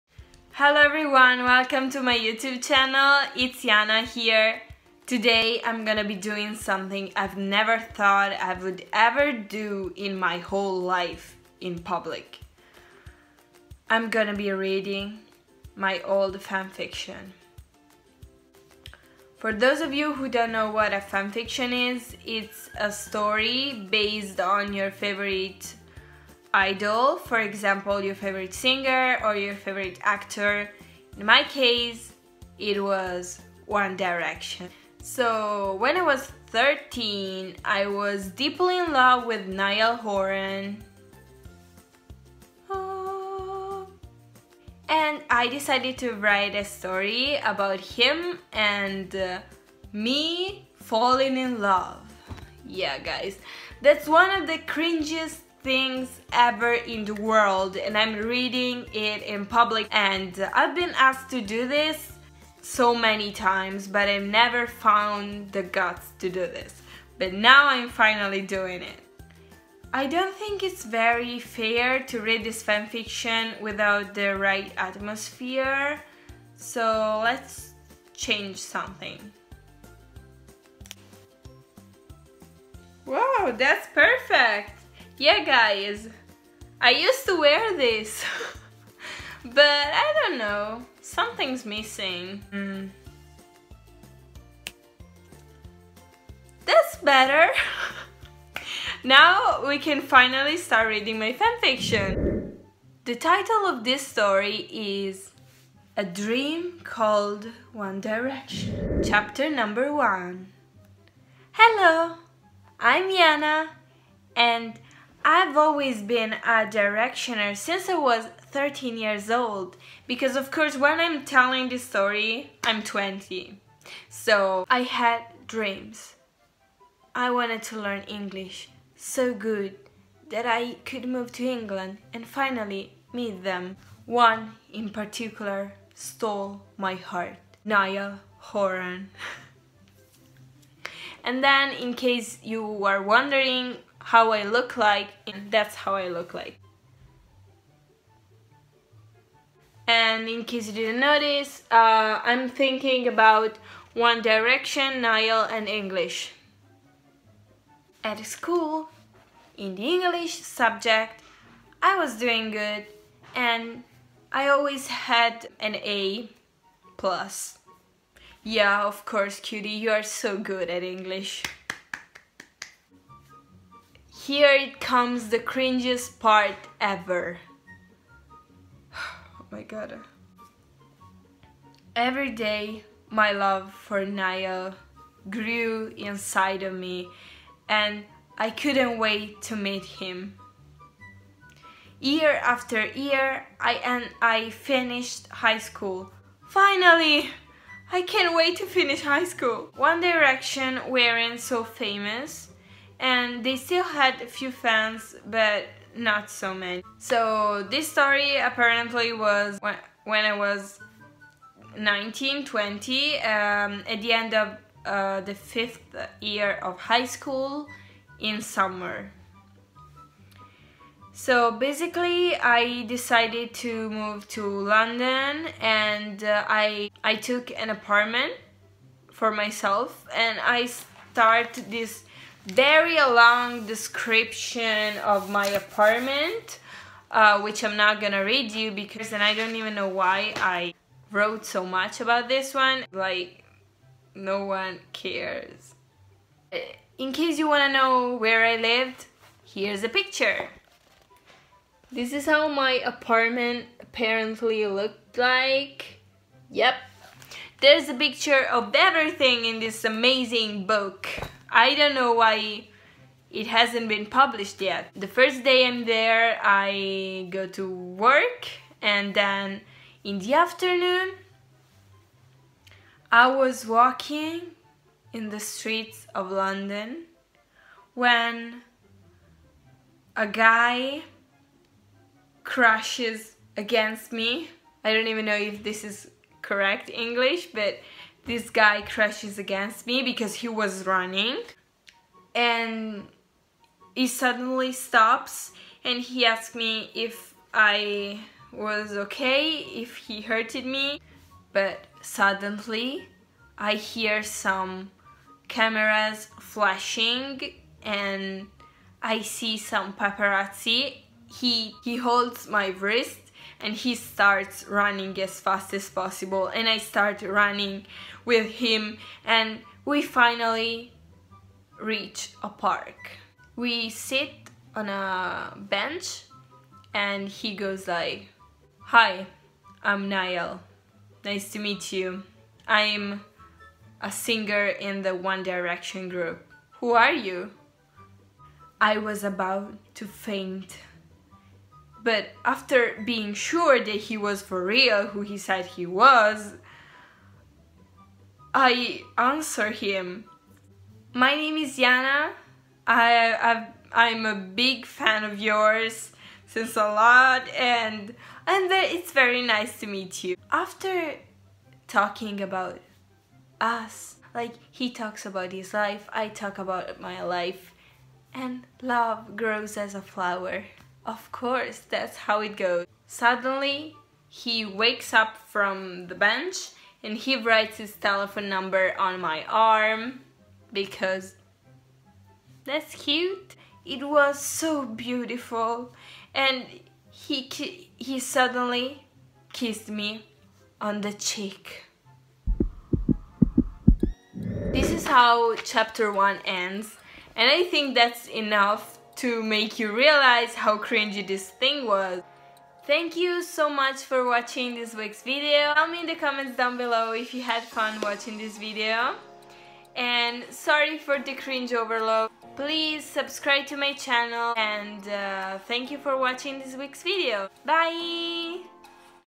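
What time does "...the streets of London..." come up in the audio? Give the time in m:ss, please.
4:35.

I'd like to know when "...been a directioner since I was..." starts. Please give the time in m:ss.
1:56.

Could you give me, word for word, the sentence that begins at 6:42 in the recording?
Thank you so much for watching this week's video.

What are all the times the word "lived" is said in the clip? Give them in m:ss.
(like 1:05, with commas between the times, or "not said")
4:08.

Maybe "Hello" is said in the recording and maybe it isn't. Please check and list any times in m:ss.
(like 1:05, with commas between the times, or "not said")
0:00, 1:51.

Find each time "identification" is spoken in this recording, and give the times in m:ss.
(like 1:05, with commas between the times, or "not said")
not said.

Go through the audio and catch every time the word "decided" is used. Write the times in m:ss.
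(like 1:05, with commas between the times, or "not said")
0:45, 3:42.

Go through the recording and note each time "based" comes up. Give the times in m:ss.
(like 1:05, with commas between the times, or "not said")
0:23.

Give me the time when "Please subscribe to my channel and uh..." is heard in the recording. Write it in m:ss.
6:52.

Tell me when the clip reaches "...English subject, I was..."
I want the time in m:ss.
2:39.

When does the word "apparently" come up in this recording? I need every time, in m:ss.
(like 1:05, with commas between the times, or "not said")
3:28, 4:13.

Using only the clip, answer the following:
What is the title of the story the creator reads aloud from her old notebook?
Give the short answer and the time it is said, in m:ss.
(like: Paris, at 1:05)
A Dream Called One Direction, at 1:45.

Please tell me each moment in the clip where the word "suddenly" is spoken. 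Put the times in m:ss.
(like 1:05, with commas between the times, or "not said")
4:54, 5:02, 6:13, 6:28.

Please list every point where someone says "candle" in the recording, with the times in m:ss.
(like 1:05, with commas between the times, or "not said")
not said.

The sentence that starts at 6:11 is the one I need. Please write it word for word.
Of course, that's how it goes.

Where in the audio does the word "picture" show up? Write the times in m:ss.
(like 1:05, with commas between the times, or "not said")
4:09, 4:17.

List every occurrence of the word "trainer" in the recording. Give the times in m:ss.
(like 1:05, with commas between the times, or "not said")
not said.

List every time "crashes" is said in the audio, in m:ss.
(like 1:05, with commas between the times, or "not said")
4:42, 4:48.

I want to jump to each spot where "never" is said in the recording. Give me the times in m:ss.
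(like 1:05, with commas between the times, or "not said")
0:07, 1:04.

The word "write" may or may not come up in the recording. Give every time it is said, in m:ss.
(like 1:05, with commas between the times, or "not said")
0:46, 6:17.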